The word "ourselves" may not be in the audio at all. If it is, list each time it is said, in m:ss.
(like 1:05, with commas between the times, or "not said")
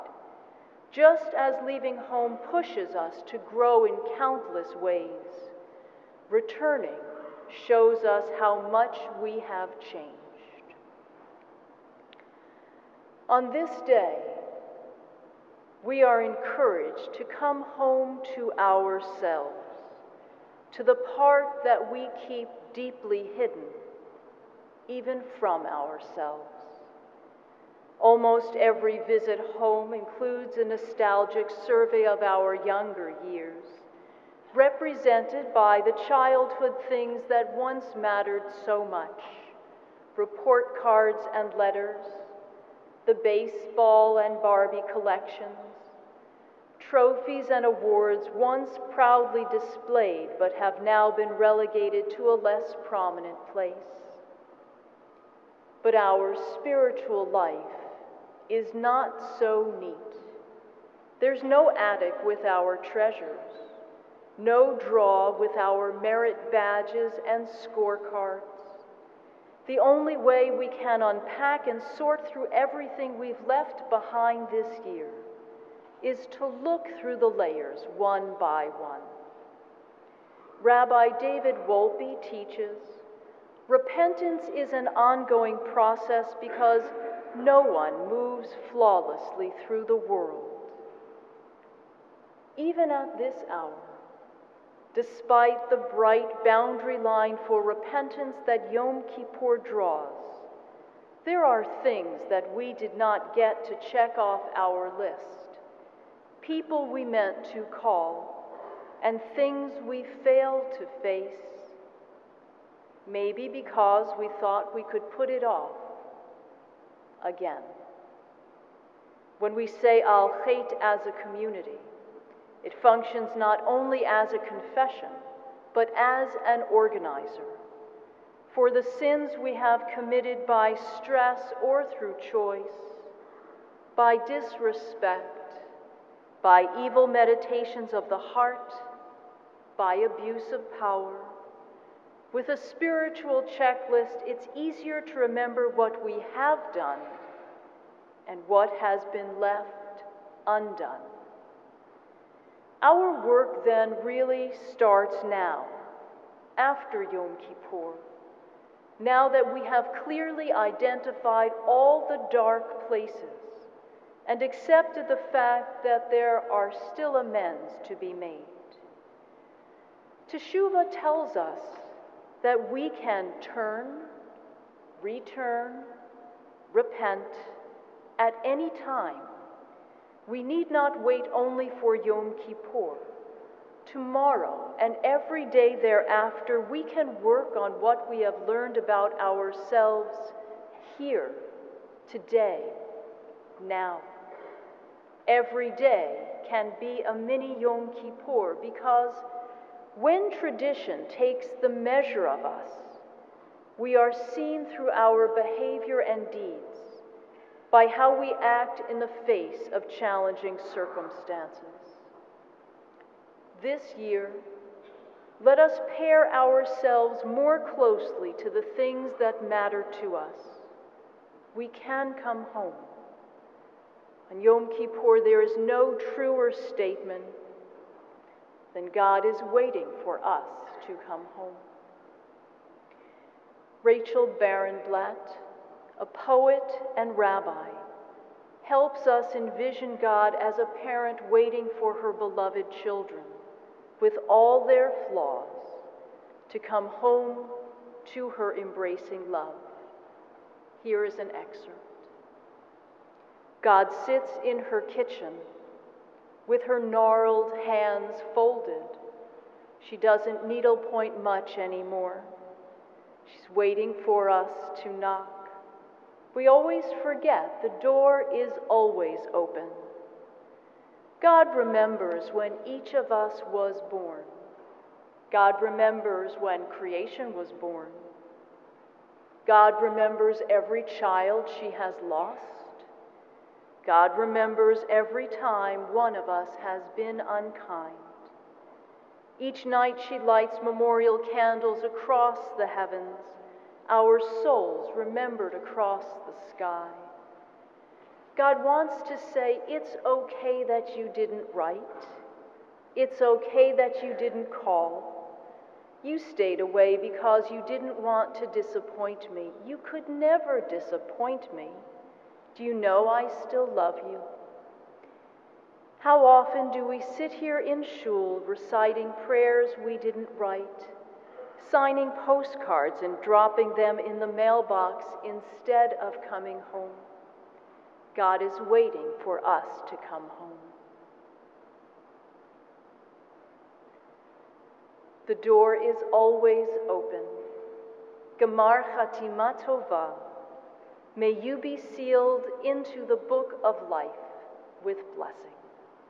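0:18, 0:25, 3:09, 3:36.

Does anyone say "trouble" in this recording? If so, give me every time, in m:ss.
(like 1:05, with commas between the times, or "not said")
not said.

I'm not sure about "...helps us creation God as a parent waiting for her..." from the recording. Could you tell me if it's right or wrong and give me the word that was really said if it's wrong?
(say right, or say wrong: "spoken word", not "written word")
wrong: "envision", not "creation".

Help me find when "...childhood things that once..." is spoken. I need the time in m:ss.
0:36.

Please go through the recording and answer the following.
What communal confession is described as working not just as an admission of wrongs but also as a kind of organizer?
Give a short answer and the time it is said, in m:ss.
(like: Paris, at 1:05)
Al chet, at 2:00.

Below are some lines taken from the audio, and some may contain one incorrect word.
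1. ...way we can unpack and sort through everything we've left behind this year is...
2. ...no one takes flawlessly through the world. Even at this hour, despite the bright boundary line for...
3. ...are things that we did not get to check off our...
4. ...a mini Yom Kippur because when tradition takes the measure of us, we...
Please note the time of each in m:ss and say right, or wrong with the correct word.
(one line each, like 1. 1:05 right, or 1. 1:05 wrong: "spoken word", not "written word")
1. 1:10 right
2. 1:27 wrong: "moves", not "takes"
3. 1:41 right
4. 3:17 right.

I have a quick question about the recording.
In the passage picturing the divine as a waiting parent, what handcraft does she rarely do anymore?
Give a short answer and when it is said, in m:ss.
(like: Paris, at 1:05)
Needlepoint, at 4:20.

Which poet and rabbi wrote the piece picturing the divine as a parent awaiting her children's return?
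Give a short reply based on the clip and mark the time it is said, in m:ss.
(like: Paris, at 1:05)
Rachel Barenblat, at 3:53.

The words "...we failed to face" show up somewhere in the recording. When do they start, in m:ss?
1:49.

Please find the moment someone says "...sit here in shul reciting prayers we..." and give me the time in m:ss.
5:17.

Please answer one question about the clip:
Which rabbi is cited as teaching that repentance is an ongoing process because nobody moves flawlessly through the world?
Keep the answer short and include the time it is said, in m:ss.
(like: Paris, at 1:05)
David Wolpe, at 1:20.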